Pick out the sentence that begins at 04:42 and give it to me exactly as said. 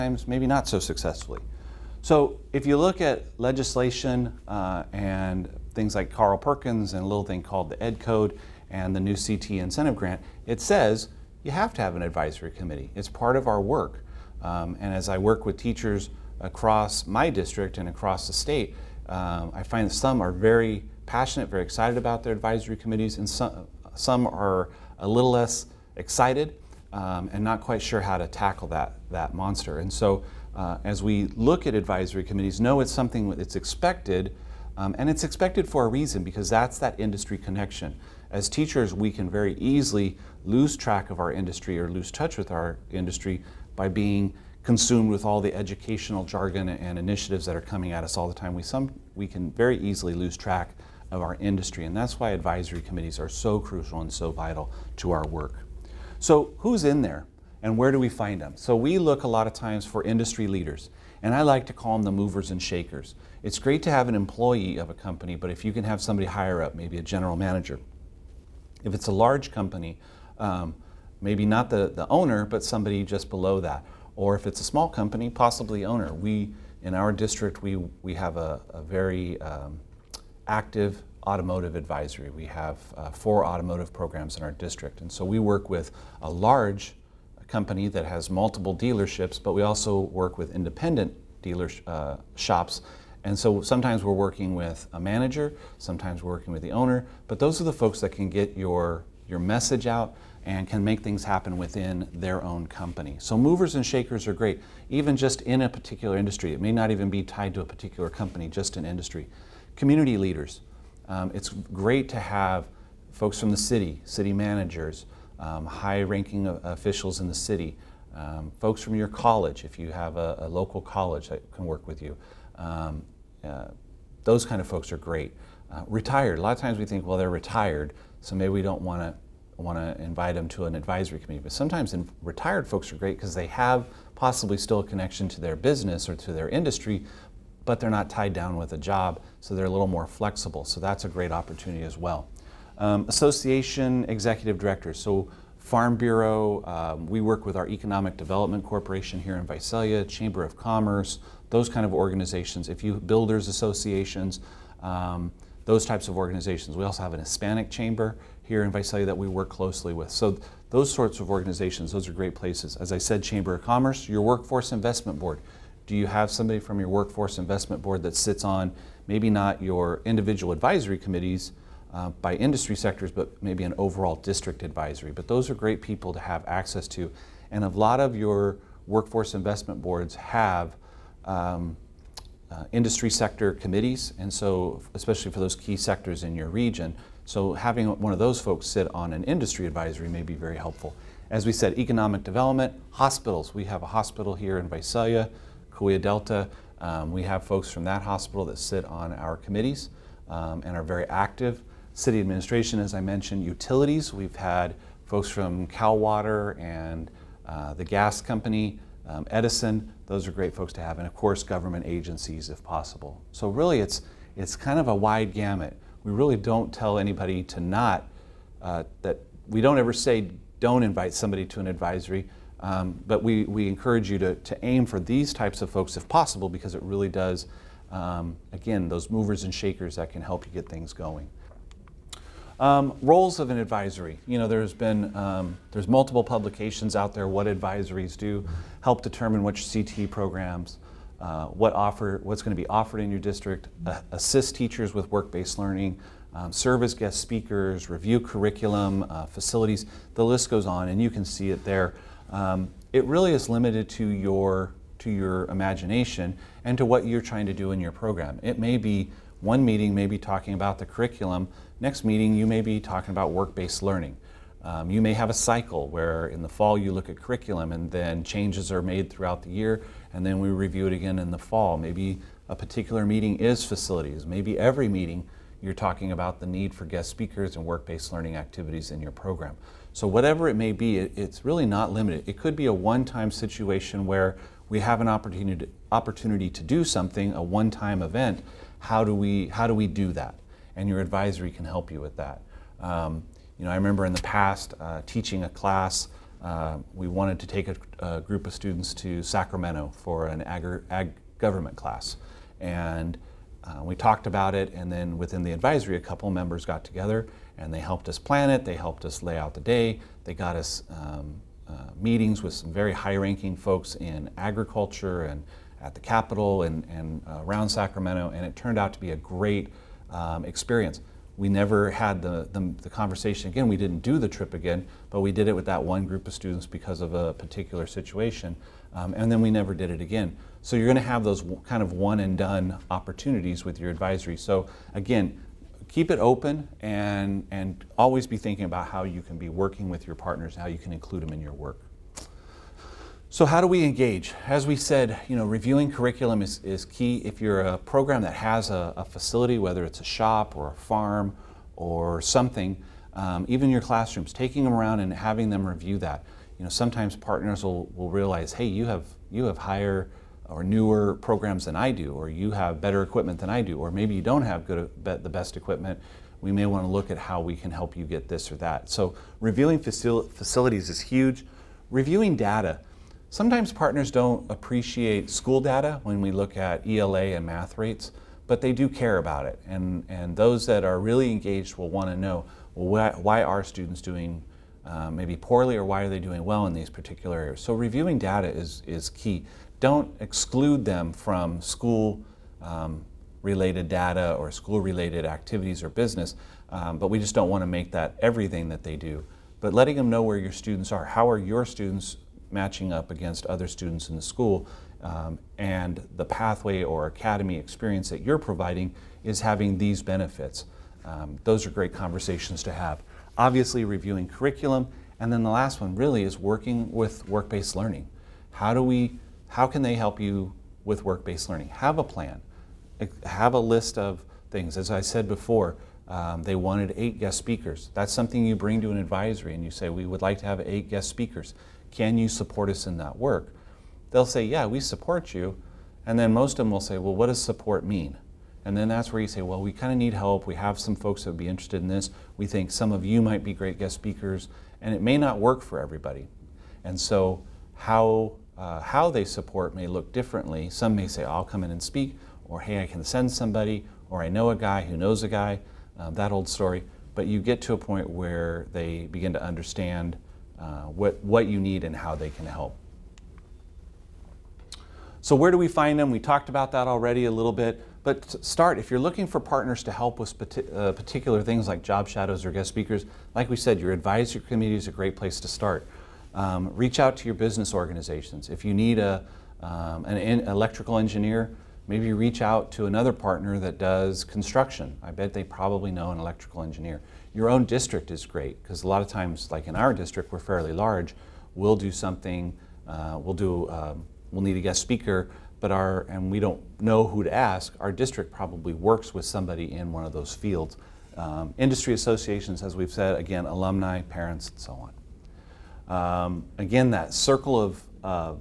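It could be a one-time situation where we have an opportunity to, opportunity to do something, a one-time event.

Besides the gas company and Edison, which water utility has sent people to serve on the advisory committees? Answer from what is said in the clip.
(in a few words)
Cal Water.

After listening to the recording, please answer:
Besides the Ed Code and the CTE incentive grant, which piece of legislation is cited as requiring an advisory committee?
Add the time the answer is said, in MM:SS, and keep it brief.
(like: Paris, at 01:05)
Carl Perkins, at 00:06.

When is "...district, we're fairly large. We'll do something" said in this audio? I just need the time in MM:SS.
08:09.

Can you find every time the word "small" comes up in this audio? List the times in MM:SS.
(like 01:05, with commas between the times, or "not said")
01:14.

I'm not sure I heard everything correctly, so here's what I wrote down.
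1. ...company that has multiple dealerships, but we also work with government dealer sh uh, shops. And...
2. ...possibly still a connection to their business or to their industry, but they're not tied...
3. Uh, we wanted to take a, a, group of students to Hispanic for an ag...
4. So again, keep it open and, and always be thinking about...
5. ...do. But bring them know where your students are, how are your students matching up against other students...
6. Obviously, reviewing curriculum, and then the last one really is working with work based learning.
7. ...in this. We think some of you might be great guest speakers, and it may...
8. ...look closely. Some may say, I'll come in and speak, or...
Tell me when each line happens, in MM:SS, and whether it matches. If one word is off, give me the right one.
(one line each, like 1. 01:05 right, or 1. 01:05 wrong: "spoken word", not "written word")
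1. 01:27 wrong: "independent", not "government"
2. 02:14 right
3. 04:56 wrong: "Sacramento", not "Hispanic"
4. 05:34 right
5. 06:38 wrong: "letting", not "bring"
6. 06:53 right
7. 07:21 right
8. 07:29 wrong: "differently", not "closely".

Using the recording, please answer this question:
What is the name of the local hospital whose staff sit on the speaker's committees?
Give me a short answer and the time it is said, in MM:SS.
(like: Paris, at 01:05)
Kaweah Delta, at 03:15.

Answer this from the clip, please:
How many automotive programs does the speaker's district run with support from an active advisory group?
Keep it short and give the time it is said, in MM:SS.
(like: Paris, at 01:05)
4, at 01:23.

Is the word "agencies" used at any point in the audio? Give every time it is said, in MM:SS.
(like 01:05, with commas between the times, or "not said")
03:31.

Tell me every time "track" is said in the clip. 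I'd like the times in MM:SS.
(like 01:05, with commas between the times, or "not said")
00:40, 00:50.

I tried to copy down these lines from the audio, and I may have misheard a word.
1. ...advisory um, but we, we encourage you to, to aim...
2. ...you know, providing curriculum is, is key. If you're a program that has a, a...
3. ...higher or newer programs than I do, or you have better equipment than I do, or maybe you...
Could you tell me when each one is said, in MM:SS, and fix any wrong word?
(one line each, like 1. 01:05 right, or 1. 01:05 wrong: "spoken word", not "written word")
1. 03:41 right
2. 05:45 wrong: "reviewing", not "providing"
3. 05:59 right.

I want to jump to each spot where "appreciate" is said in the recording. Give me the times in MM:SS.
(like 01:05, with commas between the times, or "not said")
06:14.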